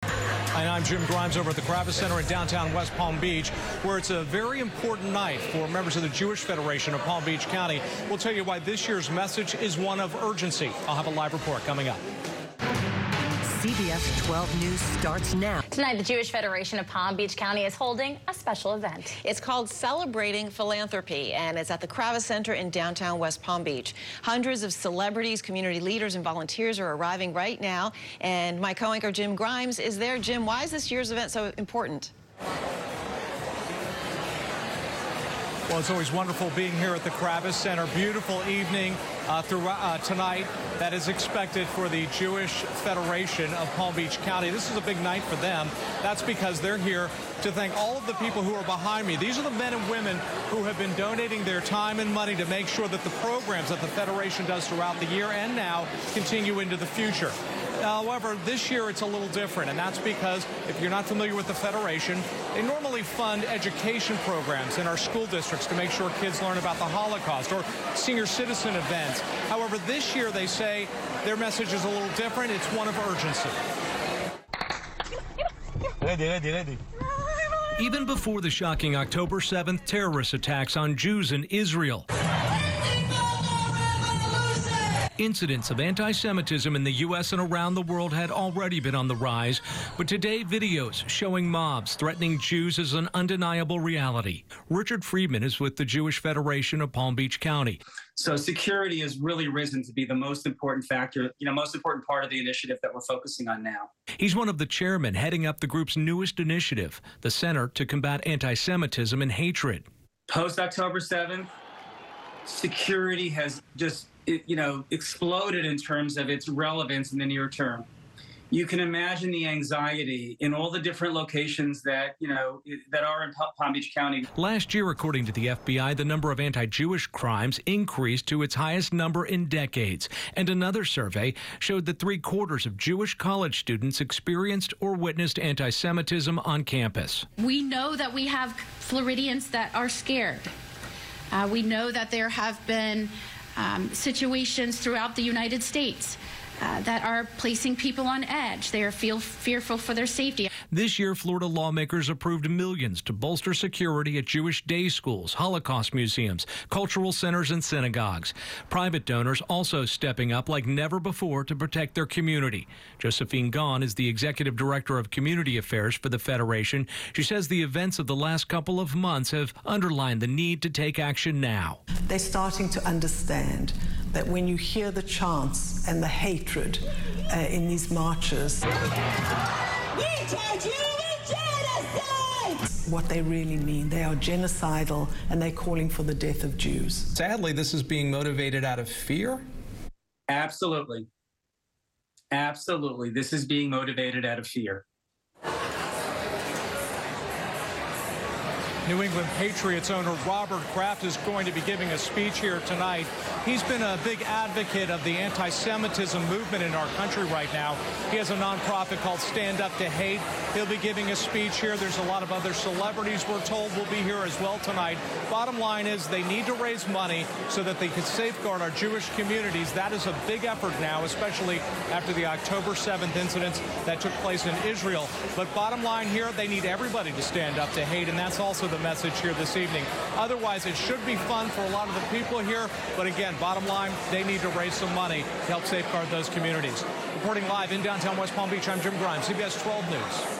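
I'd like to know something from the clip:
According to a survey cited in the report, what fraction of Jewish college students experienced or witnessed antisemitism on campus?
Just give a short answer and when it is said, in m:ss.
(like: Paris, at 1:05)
three quarters, at 2:11.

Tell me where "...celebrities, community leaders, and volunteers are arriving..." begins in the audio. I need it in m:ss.
0:24.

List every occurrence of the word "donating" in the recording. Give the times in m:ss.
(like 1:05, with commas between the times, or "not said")
0:50.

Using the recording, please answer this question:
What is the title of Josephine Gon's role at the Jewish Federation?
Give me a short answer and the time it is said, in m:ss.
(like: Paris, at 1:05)
executive director of community affairs, at 2:44.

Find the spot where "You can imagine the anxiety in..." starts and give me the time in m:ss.
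1:58.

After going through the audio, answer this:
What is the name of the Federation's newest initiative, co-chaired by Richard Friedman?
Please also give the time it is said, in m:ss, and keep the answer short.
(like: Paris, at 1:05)
Center to Combat Anti Semitism and Hatred, at 1:47.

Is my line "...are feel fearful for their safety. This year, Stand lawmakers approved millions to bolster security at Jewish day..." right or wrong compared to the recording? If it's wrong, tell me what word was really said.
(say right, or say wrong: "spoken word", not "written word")
wrong: "Florida", not "Stand".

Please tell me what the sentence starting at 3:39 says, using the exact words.
That is a big effort now, especially after the October 7th incidents that took place in Israel.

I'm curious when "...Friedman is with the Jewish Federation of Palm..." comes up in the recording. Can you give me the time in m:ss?
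1:35.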